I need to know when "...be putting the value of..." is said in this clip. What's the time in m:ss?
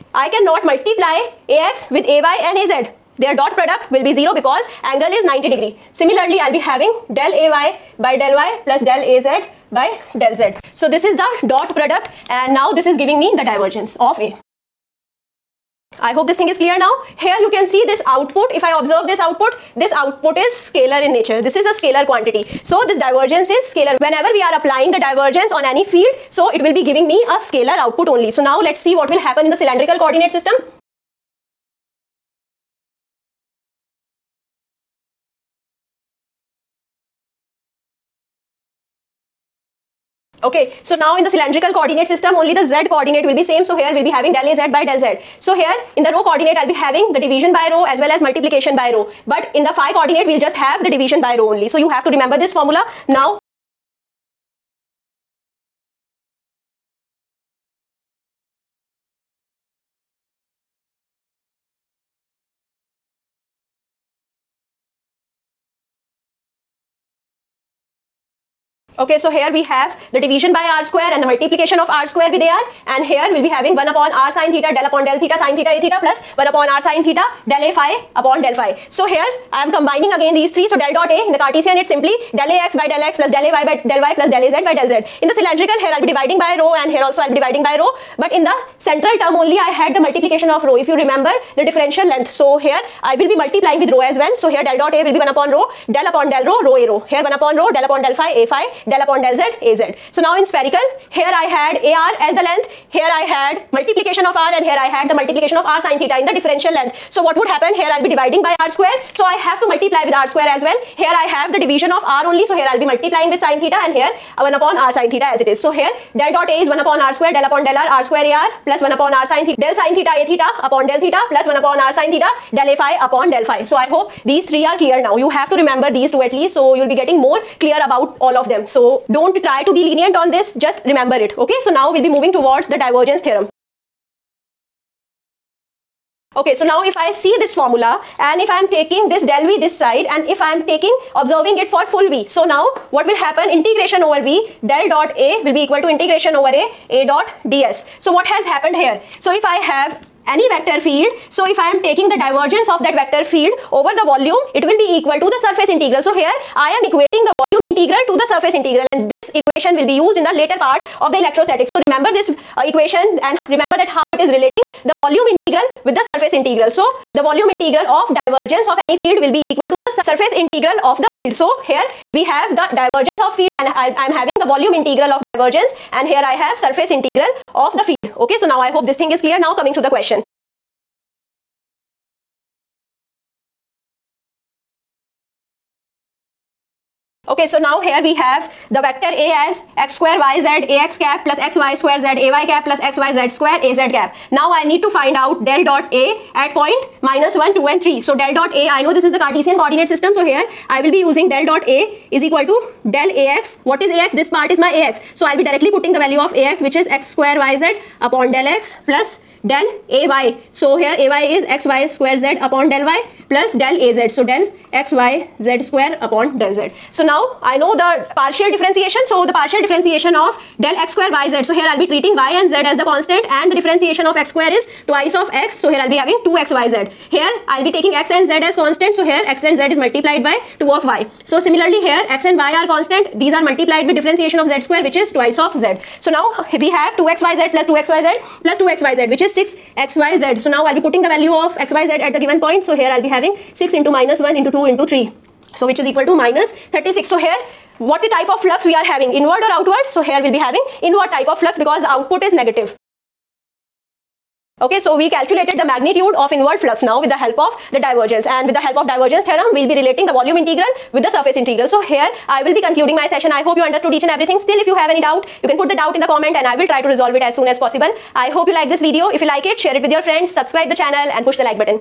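4:00.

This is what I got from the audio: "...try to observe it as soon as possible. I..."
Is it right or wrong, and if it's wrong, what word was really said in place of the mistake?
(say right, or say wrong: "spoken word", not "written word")
wrong: "resolve", not "observe".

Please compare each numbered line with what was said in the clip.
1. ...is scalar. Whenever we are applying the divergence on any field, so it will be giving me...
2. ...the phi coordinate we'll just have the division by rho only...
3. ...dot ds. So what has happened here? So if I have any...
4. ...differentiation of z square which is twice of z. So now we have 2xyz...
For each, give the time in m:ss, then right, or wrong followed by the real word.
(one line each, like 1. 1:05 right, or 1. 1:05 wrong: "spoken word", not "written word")
1. 0:23 right
2. 0:49 right
3. 2:27 right
4. 3:53 right.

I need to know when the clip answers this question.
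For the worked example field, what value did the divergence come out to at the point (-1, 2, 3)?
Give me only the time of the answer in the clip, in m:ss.
4:06.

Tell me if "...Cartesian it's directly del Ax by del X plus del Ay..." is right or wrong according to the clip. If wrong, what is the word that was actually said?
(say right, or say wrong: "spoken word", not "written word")
wrong: "simply", not "directly".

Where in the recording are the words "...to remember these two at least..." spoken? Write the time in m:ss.
2:05.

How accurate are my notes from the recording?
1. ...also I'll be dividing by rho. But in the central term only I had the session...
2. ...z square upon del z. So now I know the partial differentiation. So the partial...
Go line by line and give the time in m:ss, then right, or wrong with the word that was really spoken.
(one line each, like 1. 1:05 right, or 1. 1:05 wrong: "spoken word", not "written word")
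1. 1:27 wrong: "multiplication", not "session"
2. 3:35 right.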